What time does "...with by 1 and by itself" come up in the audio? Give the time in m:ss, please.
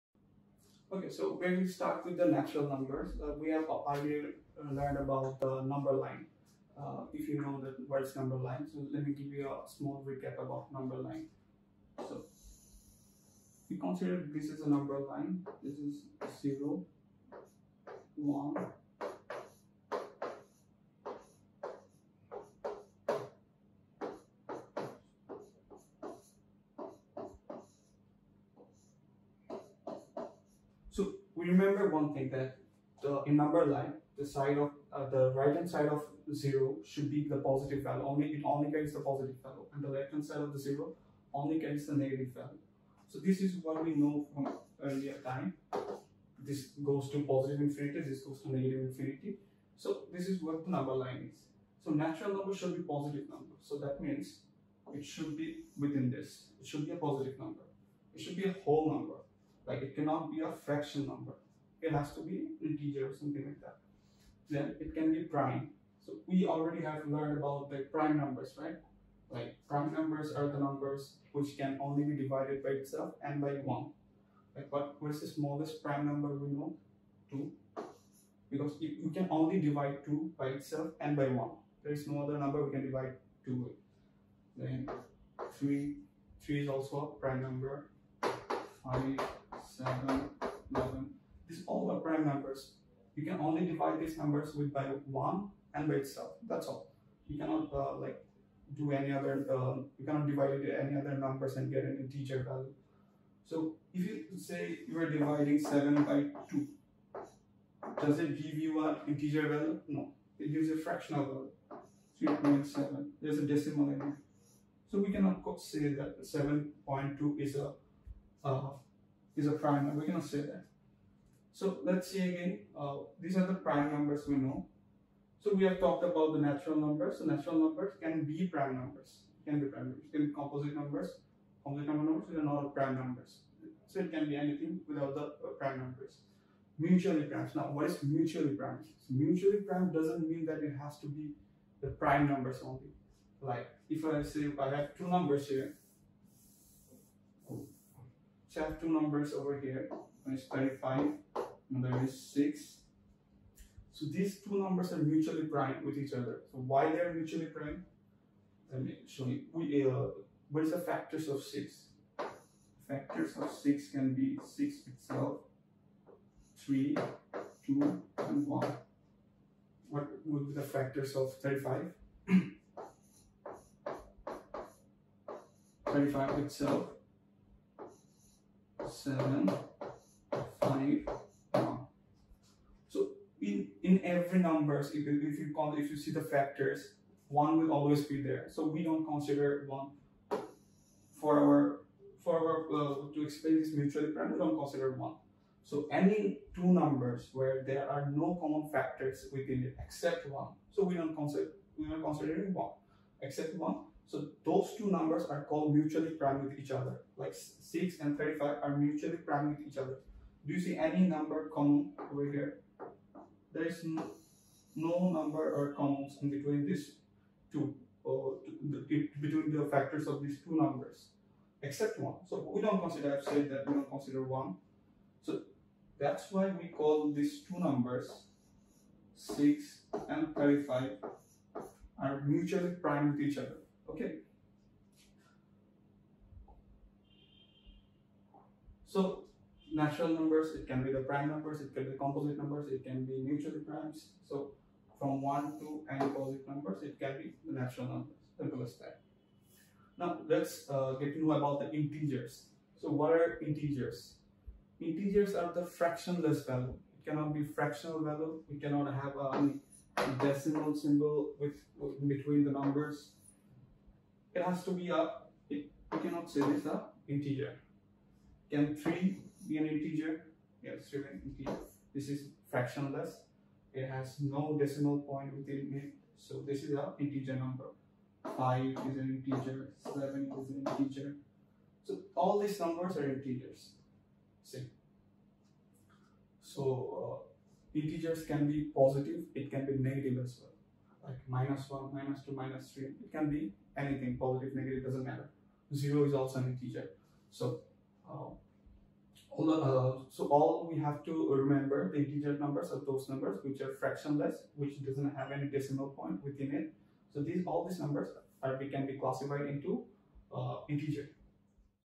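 1:34.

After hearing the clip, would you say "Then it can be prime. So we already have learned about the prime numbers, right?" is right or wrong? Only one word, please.
right.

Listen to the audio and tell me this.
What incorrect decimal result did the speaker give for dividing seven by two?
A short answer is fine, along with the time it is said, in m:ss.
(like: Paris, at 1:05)
3.7, at 1:52.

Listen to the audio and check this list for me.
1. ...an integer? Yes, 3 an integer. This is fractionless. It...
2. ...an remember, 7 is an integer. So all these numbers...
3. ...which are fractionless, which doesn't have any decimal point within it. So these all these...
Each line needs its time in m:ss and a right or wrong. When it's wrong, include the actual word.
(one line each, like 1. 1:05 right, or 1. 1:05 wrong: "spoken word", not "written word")
1. 4:29 right
2. 4:39 wrong: "integer", not "remember"
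3. 5:03 right.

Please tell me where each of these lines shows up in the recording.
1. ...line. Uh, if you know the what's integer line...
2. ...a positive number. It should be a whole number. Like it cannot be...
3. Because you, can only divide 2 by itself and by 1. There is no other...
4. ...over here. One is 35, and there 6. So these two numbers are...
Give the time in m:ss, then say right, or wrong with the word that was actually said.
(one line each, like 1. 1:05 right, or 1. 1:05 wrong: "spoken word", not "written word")
1. 0:05 wrong: "number", not "integer"
2. 0:56 right
3. 1:18 right
4. 2:29 right.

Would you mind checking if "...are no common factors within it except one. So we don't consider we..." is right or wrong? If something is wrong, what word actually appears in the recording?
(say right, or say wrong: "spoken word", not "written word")
right.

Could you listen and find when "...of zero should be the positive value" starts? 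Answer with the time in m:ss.
0:35.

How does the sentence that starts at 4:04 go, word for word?
So from 1 to n positive numbers, it can be the natural numbers, simple as that.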